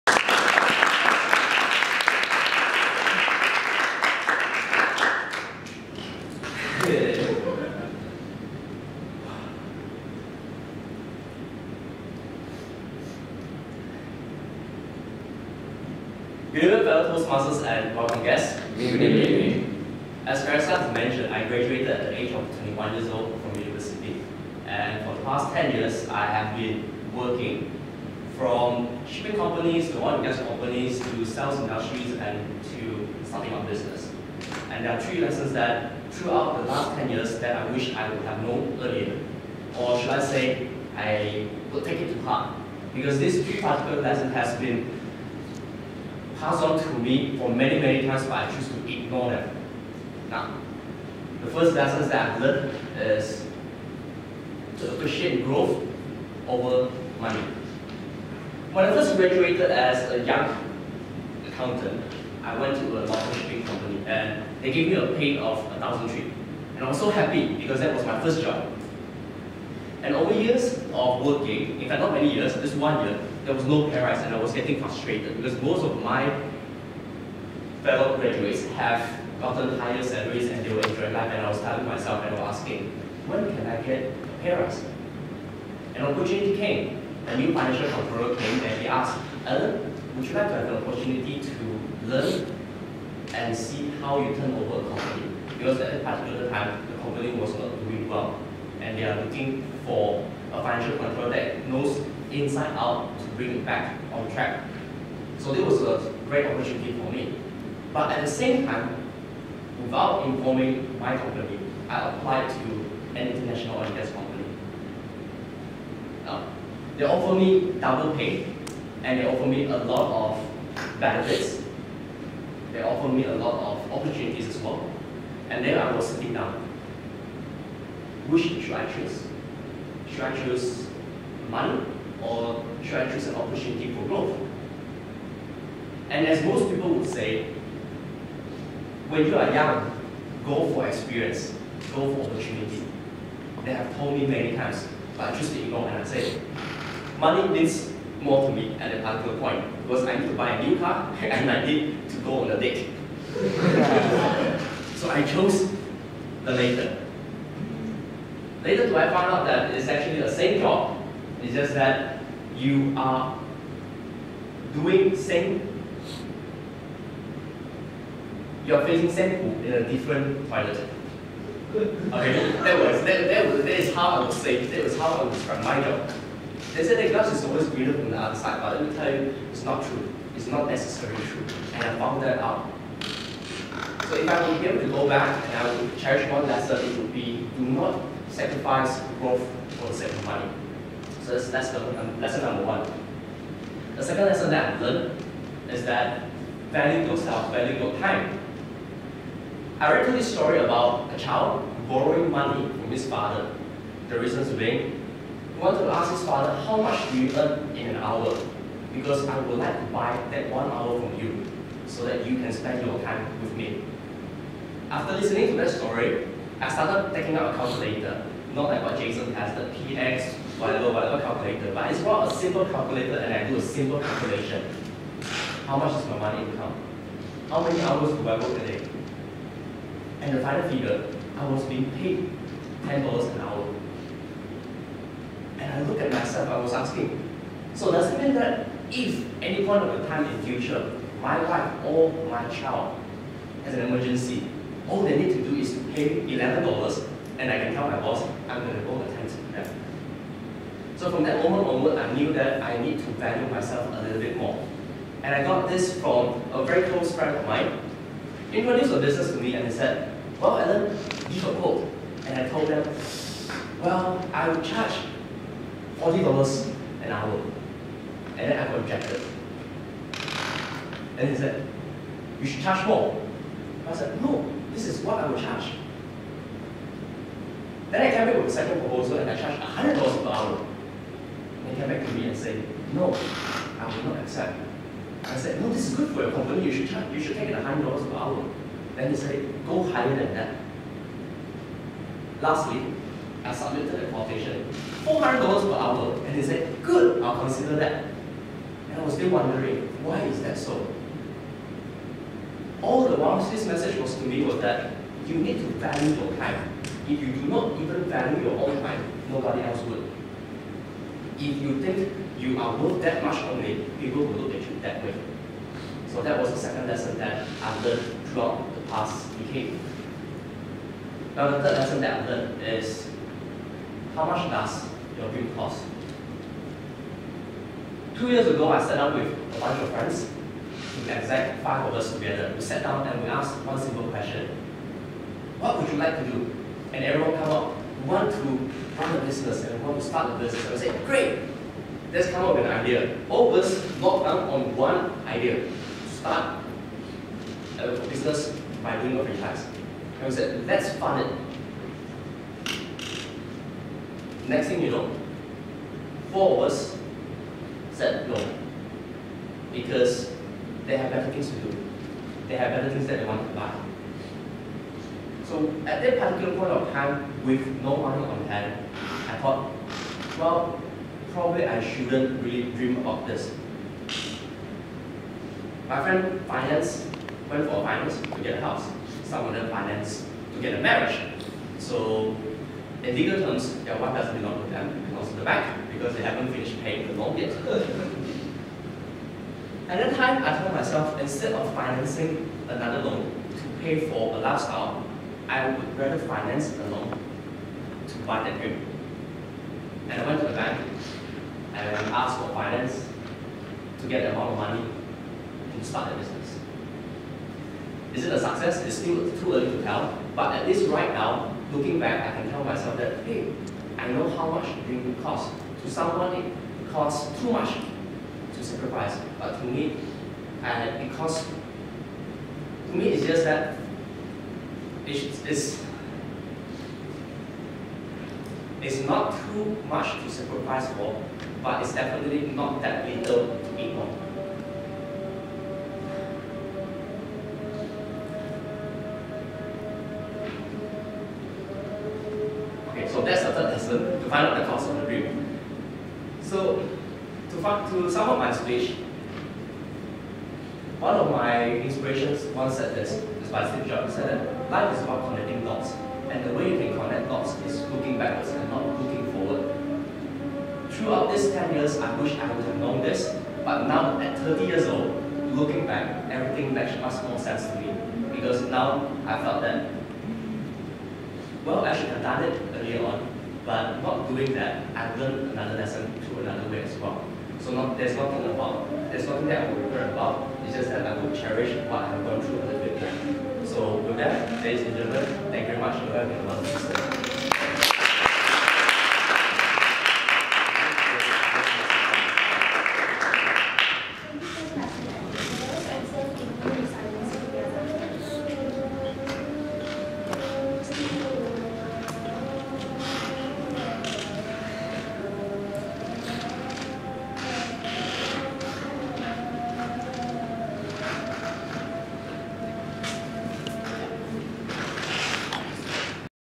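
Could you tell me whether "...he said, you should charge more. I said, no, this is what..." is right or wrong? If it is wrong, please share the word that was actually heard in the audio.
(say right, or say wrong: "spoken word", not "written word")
right.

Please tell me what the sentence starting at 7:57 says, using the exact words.
So not, there's nothing about, there's nothing that I will regret about.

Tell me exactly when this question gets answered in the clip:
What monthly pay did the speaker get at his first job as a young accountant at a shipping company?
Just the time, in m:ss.
1:05.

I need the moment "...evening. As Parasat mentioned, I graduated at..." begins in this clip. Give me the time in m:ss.
0:19.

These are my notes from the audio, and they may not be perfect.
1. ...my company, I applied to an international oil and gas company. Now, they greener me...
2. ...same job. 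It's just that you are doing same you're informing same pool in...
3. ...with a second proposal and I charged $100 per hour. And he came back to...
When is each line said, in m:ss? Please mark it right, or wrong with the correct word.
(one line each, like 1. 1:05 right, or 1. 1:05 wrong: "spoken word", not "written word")
1. 1:50 wrong: "offer", not "greener"
2. 2:40 wrong: "facing", not "informing"
3. 4:38 right.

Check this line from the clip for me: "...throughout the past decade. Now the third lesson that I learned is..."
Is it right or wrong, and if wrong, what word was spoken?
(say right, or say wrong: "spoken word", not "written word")
right.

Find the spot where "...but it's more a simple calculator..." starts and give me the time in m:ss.
3:41.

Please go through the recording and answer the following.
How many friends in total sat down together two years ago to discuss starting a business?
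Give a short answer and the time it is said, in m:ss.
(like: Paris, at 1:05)
5, at 5:31.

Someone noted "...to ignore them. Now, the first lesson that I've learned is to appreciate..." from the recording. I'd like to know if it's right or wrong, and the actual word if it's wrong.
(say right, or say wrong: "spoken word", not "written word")
right.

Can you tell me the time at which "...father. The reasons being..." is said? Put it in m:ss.
3:23.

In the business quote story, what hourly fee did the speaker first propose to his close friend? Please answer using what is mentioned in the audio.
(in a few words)
$40.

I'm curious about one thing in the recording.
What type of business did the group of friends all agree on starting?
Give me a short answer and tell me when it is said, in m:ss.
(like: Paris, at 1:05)
franchise, at 5:49.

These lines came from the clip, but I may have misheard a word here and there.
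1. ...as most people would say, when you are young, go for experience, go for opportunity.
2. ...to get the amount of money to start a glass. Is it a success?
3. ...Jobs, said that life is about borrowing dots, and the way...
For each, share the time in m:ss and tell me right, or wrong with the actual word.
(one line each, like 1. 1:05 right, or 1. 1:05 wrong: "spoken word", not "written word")
1. 2:16 right
2. 6:44 wrong: "business", not "glass"
3. 7:33 wrong: "connecting", not "borrowing".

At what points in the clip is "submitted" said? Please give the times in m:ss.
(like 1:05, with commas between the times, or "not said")
4:53.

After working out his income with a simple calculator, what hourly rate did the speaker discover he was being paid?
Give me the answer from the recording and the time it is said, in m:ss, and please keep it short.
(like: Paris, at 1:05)
$10, at 3:52.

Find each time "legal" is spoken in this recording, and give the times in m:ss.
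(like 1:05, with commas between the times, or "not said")
6:23.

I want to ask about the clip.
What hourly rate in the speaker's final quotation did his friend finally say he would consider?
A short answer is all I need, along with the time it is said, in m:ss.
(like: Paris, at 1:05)
$400, at 4:55.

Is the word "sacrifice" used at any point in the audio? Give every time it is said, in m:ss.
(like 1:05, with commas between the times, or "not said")
3:08, 6:58, 7:10.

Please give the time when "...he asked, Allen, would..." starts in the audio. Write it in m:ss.
1:28.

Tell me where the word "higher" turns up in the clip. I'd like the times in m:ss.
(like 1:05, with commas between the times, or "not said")
1:19, 4:49.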